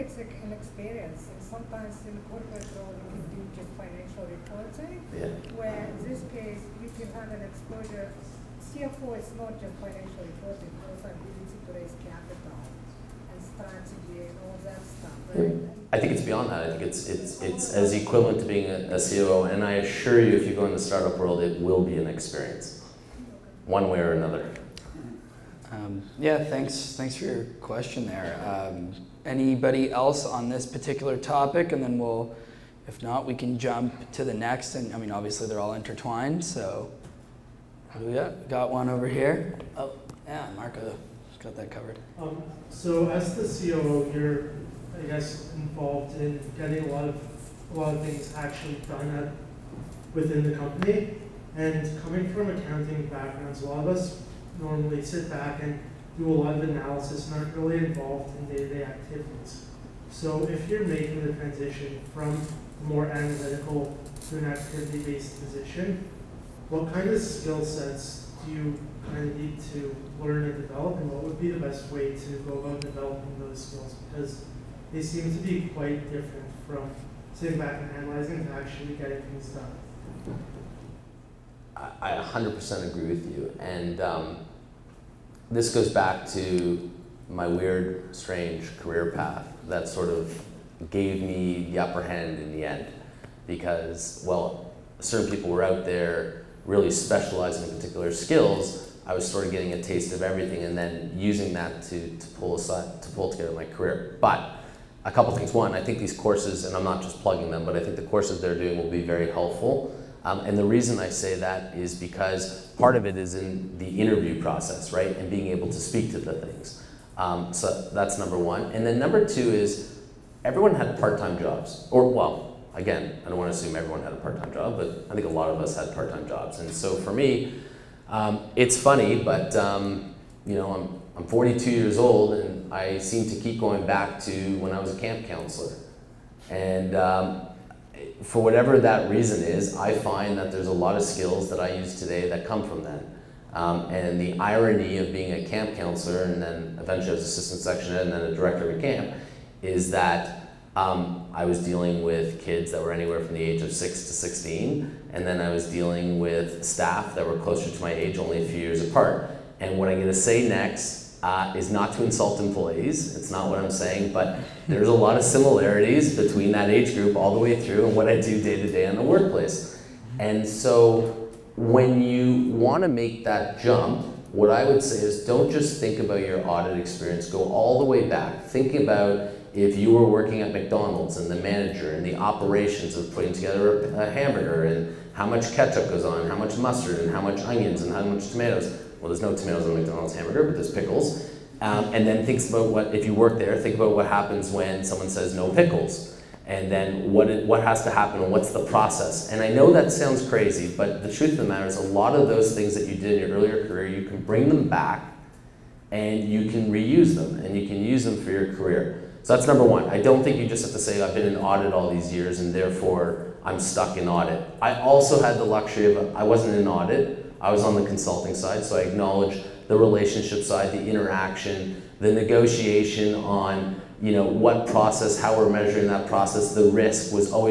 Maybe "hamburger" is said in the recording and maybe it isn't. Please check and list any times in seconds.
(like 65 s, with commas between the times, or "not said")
184 s, 190 s.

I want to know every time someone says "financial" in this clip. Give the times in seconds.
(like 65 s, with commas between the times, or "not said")
3 s, 9 s.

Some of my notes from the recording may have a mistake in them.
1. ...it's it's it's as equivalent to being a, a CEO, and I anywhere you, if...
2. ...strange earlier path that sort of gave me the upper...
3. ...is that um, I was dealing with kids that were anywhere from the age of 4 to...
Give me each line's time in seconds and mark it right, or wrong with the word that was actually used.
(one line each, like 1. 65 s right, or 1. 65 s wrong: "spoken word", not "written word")
1. 16 s wrong: "assure", not "anywhere"
2. 88 s wrong: "career", not "earlier"
3. 149 s wrong: "6", not "4".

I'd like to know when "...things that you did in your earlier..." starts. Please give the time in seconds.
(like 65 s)
202 s.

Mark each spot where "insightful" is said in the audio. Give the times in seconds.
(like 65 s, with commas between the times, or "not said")
not said.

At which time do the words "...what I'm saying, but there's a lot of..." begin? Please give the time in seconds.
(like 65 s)
163 s.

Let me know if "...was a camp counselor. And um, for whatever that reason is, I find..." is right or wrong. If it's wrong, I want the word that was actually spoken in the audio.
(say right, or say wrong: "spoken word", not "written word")
right.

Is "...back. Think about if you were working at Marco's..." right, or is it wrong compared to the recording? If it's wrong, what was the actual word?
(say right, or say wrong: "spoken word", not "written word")
wrong: "McDonald", not "Marco".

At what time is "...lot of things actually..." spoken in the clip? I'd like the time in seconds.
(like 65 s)
47 s.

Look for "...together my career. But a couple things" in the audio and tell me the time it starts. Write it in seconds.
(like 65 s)
103 s.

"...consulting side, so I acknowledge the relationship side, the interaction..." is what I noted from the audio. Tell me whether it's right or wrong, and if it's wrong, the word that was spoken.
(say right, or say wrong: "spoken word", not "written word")
right.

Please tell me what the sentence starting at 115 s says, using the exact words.
And being able to speak to the things.